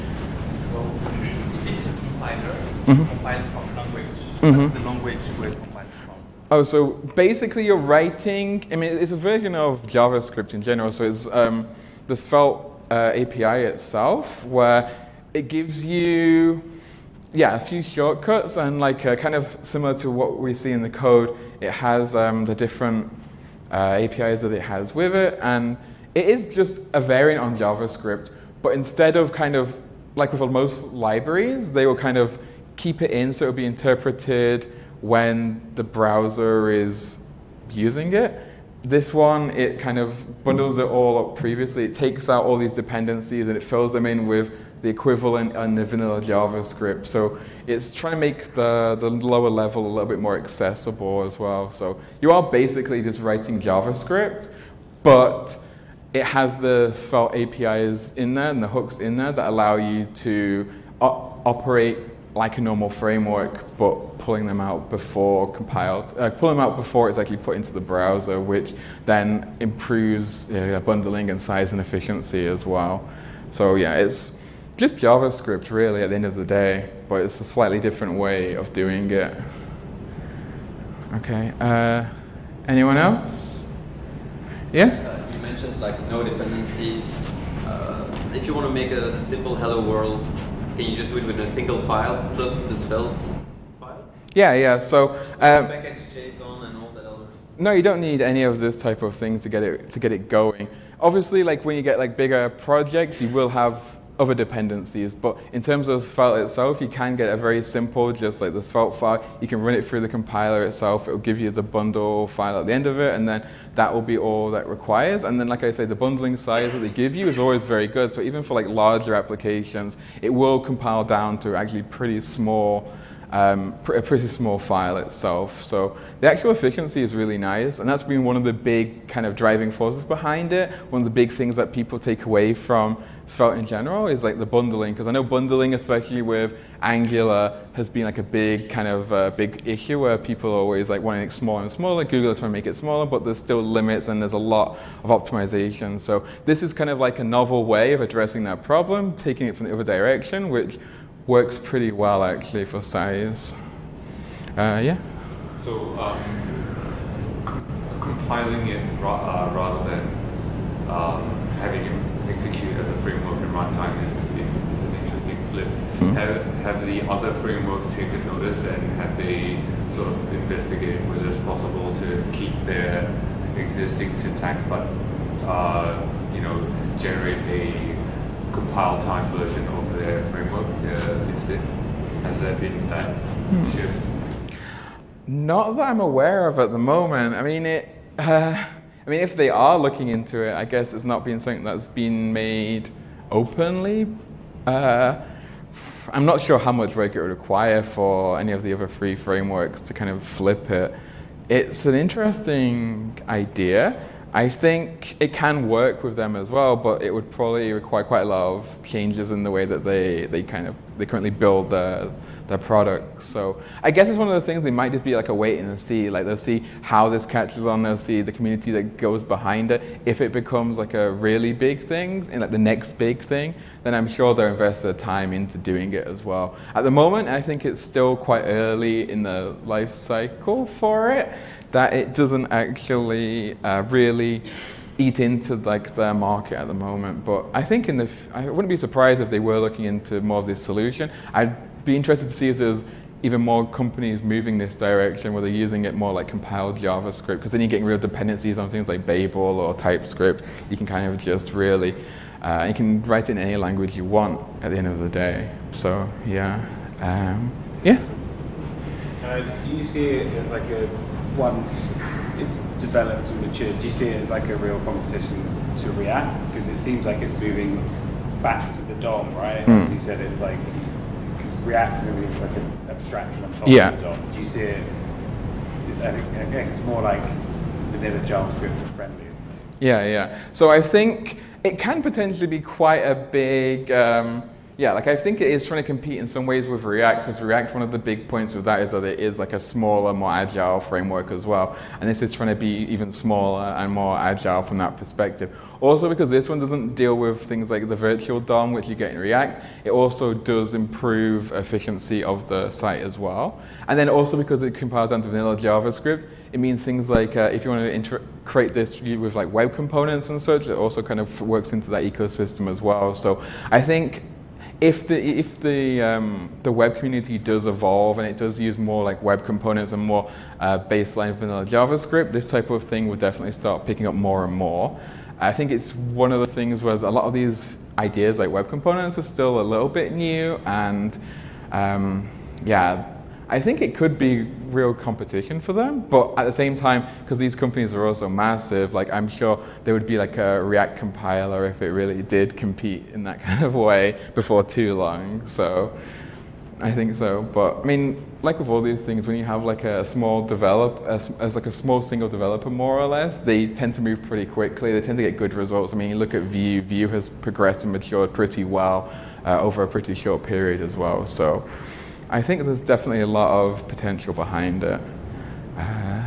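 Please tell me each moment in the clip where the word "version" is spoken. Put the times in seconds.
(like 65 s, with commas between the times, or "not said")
9 s, 179 s.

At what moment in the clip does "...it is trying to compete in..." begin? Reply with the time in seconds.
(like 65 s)
285 s.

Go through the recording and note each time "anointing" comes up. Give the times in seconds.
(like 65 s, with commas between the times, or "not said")
not said.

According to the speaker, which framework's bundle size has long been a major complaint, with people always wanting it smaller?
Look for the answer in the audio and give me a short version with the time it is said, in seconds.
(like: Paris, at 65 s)
Angular, at 136 s.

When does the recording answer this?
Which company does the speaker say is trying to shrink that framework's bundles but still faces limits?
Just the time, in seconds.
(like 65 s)
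142 s.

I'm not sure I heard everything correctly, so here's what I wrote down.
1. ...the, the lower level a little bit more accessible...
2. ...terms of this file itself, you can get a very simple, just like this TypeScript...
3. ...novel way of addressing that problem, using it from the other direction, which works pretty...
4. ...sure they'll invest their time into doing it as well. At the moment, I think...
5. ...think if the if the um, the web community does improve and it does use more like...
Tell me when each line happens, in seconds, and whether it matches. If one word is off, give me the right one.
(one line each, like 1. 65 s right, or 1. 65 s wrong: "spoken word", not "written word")
1. 48 s right
2. 105 s wrong: "Svelte", not "TypeScript"
3. 147 s wrong: "taking", not "using"
4. 224 s right
5. 313 s wrong: "evolve", not "improve".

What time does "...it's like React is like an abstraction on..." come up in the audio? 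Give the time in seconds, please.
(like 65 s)
270 s.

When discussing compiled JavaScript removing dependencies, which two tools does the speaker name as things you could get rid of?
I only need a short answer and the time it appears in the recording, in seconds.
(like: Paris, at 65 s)
Babel or TypeScript, at 249 s.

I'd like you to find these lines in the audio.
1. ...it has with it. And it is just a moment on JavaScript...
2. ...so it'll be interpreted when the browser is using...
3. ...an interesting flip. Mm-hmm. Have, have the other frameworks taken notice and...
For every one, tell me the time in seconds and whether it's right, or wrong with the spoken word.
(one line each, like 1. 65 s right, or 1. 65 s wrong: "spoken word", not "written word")
1. 24 s wrong: "variant", not "moment"
2. 33 s right
3. 164 s right.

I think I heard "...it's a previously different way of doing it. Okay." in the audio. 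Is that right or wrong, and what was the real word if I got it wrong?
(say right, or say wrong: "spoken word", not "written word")
wrong: "slightly", not "previously".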